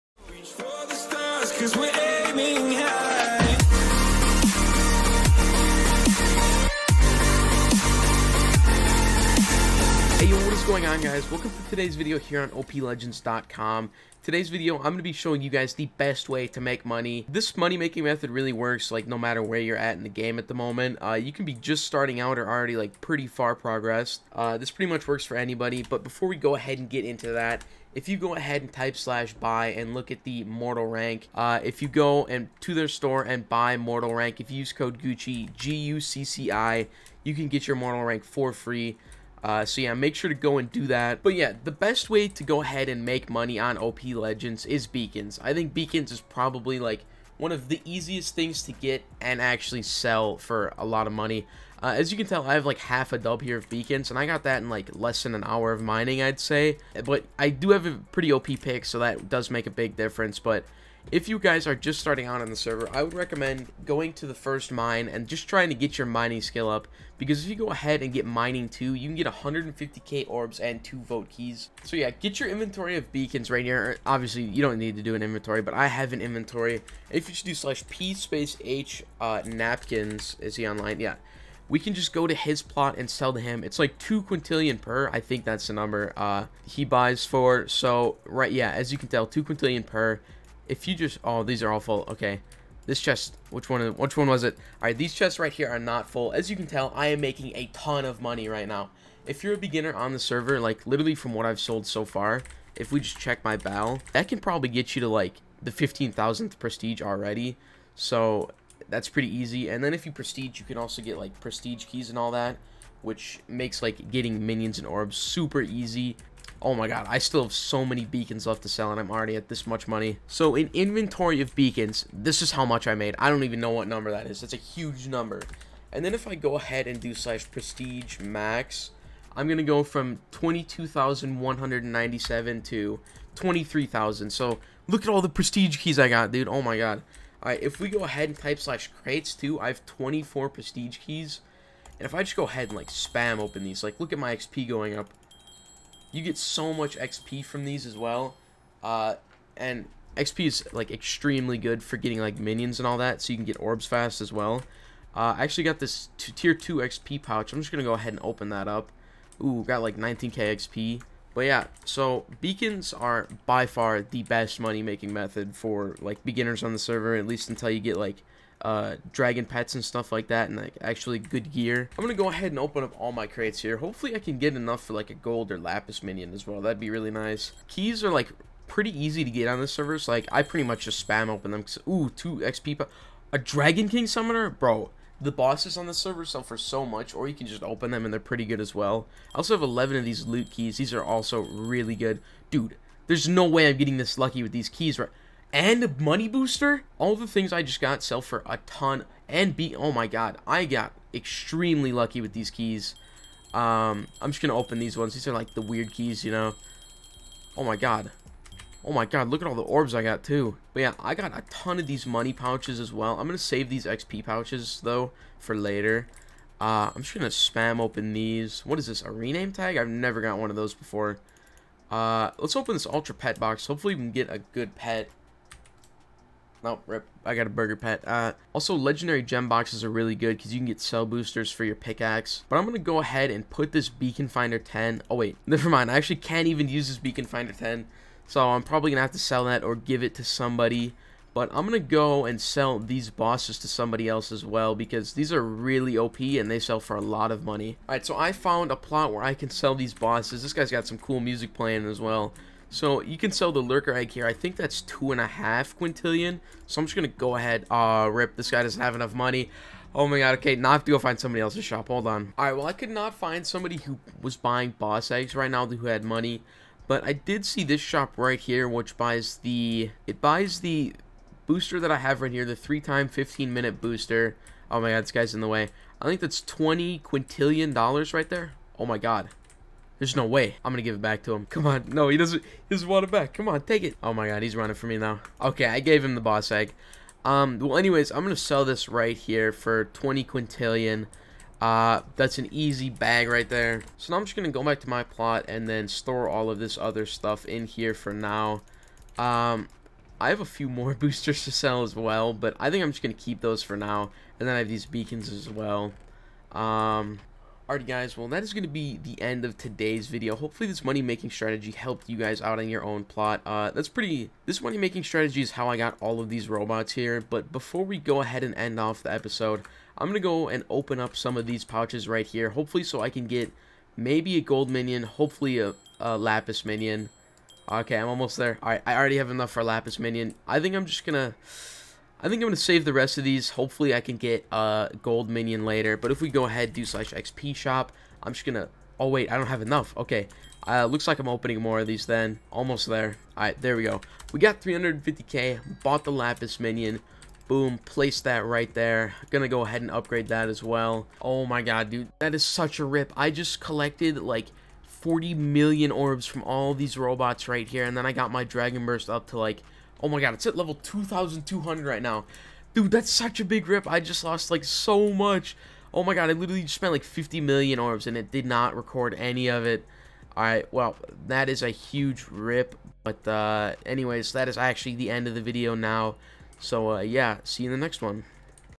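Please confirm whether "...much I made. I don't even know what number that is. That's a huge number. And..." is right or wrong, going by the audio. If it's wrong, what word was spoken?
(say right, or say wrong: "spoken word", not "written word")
right.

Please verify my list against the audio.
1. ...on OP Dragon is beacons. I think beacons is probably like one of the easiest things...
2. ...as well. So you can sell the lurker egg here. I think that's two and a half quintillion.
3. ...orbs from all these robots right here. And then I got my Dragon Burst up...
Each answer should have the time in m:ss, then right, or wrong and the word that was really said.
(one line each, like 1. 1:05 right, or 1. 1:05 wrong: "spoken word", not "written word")
1. 0:43 wrong: "Legends", not "Dragon"
2. 4:11 right
3. 5:55 right.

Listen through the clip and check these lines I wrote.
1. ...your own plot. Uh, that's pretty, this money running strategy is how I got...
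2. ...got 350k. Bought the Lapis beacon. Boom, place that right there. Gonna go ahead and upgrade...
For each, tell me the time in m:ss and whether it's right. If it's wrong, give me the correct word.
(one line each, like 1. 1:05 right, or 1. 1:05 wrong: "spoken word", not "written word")
1. 5:12 wrong: "making", not "running"
2. 5:44 wrong: "minion", not "beacon".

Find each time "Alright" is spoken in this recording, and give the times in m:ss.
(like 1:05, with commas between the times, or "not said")
2:17, 4:07, 4:22, 5:07, 5:28, 6:10.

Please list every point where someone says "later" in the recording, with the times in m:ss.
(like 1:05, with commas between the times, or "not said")
3:35, 5:35.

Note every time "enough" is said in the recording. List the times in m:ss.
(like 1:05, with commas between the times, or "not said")
2:54, 4:18, 5:29, 5:39.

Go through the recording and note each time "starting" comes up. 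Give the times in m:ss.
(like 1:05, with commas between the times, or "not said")
0:21, 1:01.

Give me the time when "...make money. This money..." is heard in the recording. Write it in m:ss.
0:16.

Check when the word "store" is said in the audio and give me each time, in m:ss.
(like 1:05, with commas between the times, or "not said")
0:32, 4:55.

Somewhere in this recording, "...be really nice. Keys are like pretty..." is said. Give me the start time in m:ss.
2:56.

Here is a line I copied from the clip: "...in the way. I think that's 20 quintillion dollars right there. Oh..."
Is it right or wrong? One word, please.
right.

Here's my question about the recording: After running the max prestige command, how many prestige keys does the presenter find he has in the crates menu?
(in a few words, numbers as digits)
24.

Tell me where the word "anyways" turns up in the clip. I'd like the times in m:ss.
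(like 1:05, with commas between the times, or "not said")
4:47, 6:13.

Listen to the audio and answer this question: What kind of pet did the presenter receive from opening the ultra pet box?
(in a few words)
burger pet.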